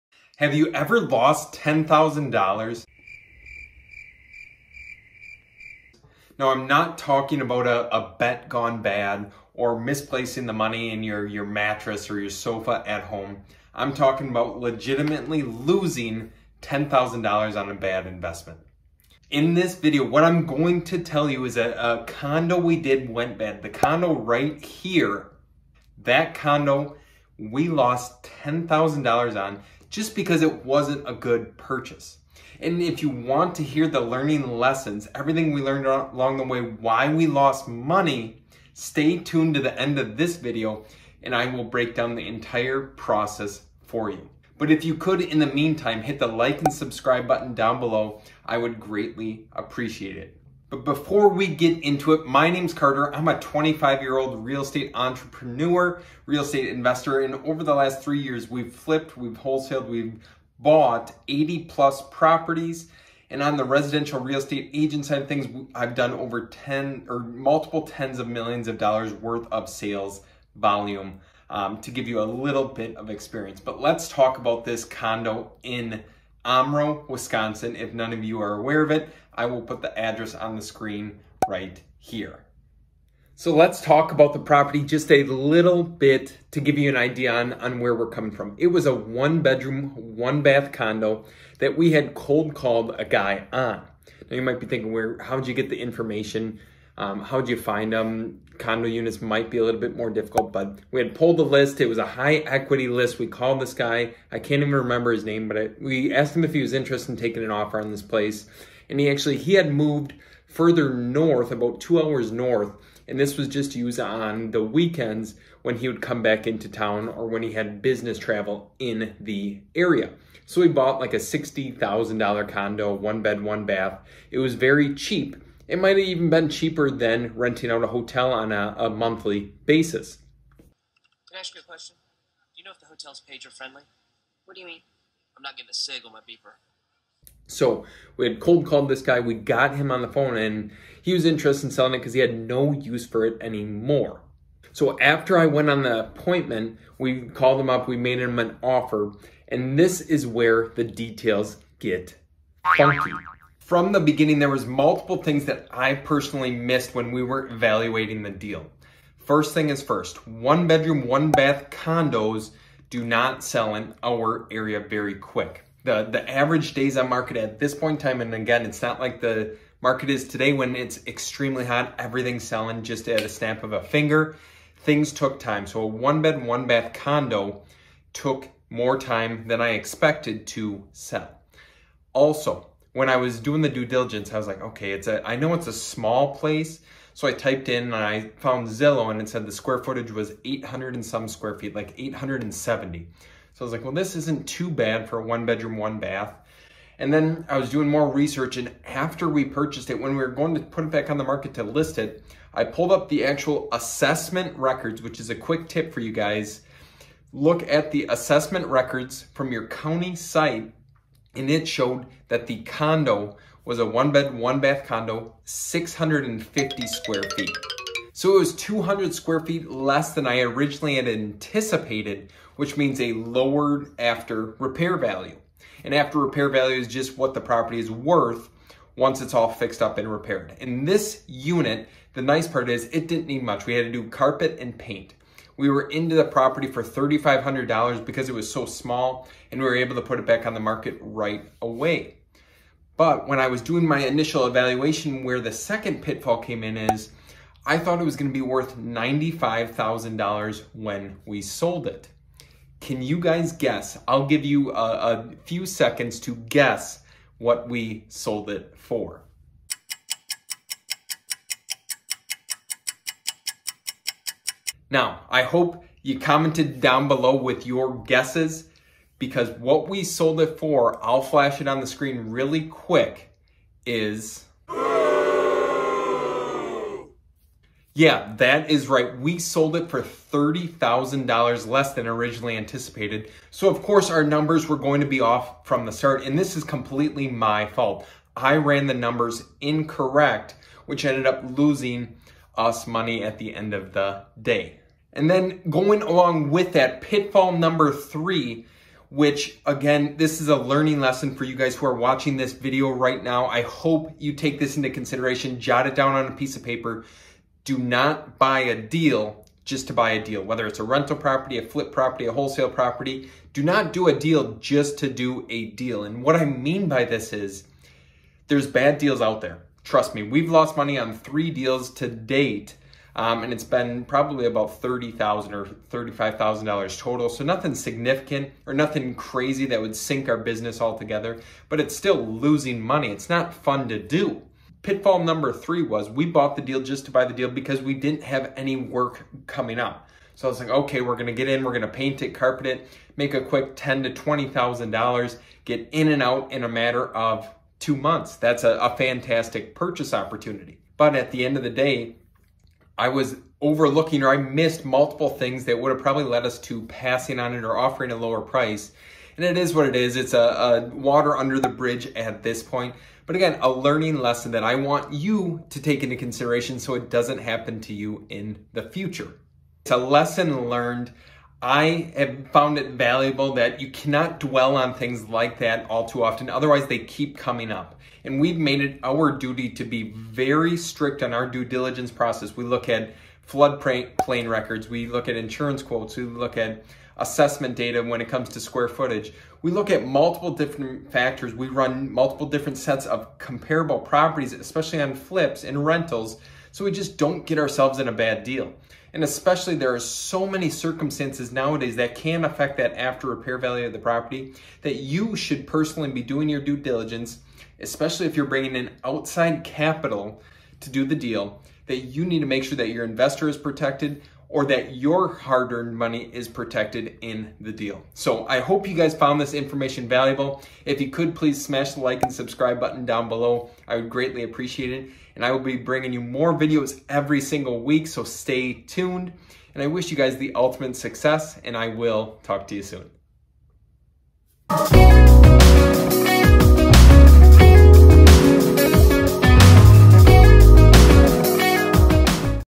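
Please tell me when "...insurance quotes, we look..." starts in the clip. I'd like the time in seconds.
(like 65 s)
385 s.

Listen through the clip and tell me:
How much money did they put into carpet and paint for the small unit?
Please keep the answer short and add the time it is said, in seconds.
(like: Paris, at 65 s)
$3,500, at 236 s.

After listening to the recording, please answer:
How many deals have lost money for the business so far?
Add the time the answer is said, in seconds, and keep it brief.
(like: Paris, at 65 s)
3, at 321 s.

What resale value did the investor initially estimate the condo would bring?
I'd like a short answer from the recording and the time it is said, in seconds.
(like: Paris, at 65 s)
$95,000, at 248 s.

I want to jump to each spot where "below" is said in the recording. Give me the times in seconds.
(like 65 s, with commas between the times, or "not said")
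47 s, 267 s, 423 s.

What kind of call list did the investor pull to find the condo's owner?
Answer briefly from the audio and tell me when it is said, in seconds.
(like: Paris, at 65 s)
High equity list, at 102 s.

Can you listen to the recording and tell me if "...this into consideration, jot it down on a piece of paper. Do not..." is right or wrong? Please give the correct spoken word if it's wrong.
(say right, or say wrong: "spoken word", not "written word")
right.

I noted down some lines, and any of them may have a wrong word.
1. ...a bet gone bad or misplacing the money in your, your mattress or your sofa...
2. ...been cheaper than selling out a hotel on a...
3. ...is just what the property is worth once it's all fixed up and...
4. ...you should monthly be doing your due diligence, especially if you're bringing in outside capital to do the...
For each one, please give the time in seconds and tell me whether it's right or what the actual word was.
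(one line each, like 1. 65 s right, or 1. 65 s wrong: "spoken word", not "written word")
1. 7 s right
2. 126 s wrong: "renting", not "selling"
3. 226 s right
4. 404 s wrong: "personally", not "monthly".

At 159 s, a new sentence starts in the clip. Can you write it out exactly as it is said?
First thing is first, one bedroom, one bath condos do not sell in our area very quick.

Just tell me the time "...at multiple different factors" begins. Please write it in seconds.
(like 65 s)
389 s.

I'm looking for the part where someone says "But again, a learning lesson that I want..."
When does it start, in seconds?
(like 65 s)
363 s.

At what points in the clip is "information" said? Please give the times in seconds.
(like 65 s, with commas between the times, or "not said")
95 s, 419 s.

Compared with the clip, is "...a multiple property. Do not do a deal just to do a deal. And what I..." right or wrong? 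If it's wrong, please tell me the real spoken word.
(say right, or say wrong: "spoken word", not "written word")
wrong: "wholesale", not "multiple".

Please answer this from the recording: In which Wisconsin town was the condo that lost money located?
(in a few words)
Omro.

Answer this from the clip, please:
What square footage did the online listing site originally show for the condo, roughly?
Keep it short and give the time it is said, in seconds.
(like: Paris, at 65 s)
870, at 191 s.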